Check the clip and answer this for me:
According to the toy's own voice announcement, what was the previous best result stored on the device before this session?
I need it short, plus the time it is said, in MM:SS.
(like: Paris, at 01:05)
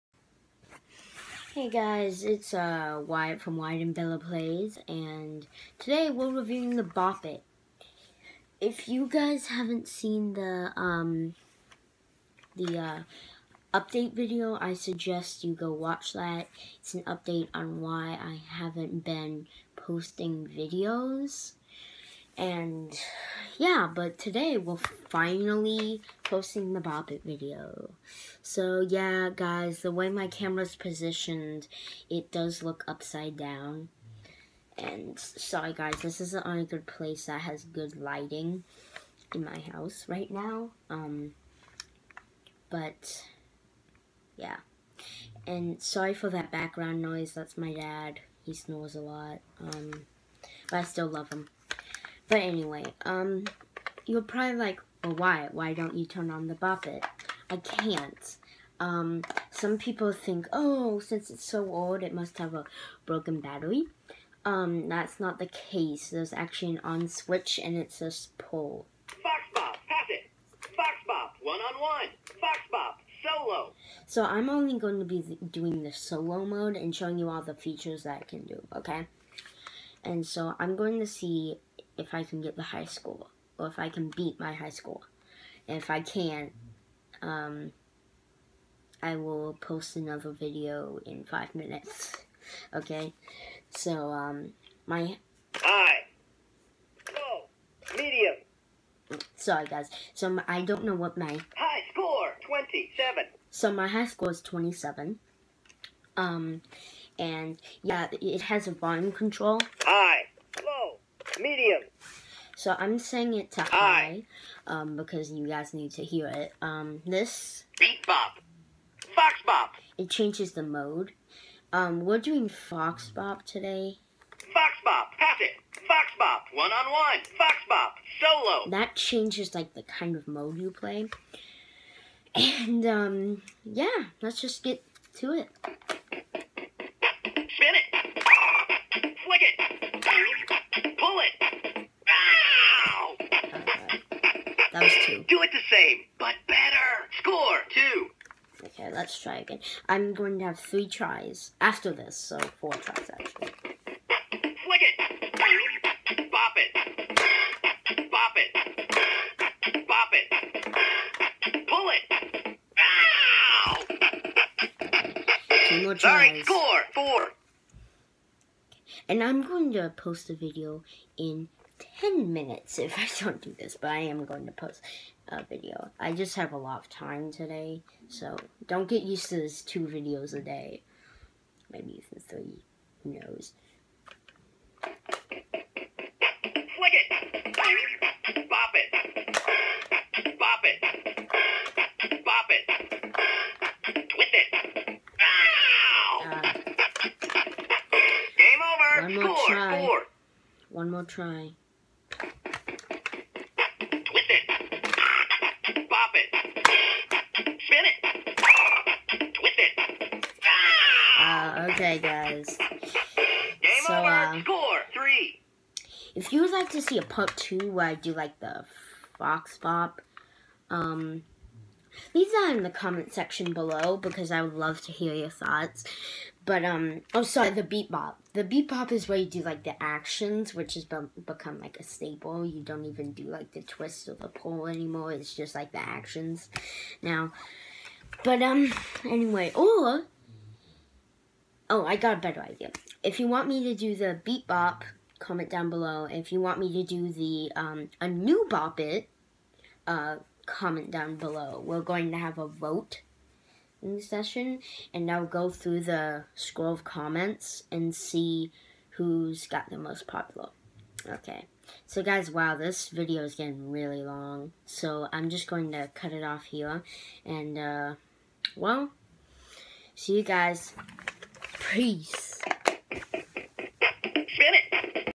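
27, at 01:41.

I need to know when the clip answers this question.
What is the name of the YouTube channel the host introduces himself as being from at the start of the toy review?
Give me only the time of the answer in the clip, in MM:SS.
00:03.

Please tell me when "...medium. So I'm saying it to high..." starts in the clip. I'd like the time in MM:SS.
01:51.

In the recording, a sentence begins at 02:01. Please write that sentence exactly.
Um, we're doing fox bop today.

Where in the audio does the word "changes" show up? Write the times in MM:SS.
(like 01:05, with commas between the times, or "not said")
02:00, 02:08.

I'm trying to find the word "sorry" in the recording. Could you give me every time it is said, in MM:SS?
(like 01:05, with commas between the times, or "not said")
00:35, 00:45, 01:39, 02:46, 03:47.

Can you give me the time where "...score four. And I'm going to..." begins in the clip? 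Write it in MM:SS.
02:46.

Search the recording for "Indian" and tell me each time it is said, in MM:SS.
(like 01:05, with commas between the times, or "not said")
not said.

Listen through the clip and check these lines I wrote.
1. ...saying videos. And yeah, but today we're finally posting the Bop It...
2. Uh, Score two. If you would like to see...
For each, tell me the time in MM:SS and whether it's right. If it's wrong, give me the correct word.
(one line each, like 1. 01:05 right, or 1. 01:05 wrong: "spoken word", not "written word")
1. 00:19 wrong: "posting", not "saying"
2. 03:34 wrong: "three", not "two".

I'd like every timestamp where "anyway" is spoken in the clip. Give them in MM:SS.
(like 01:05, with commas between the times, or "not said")
00:52, 03:59.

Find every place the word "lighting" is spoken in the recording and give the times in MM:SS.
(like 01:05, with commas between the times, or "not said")
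00:37.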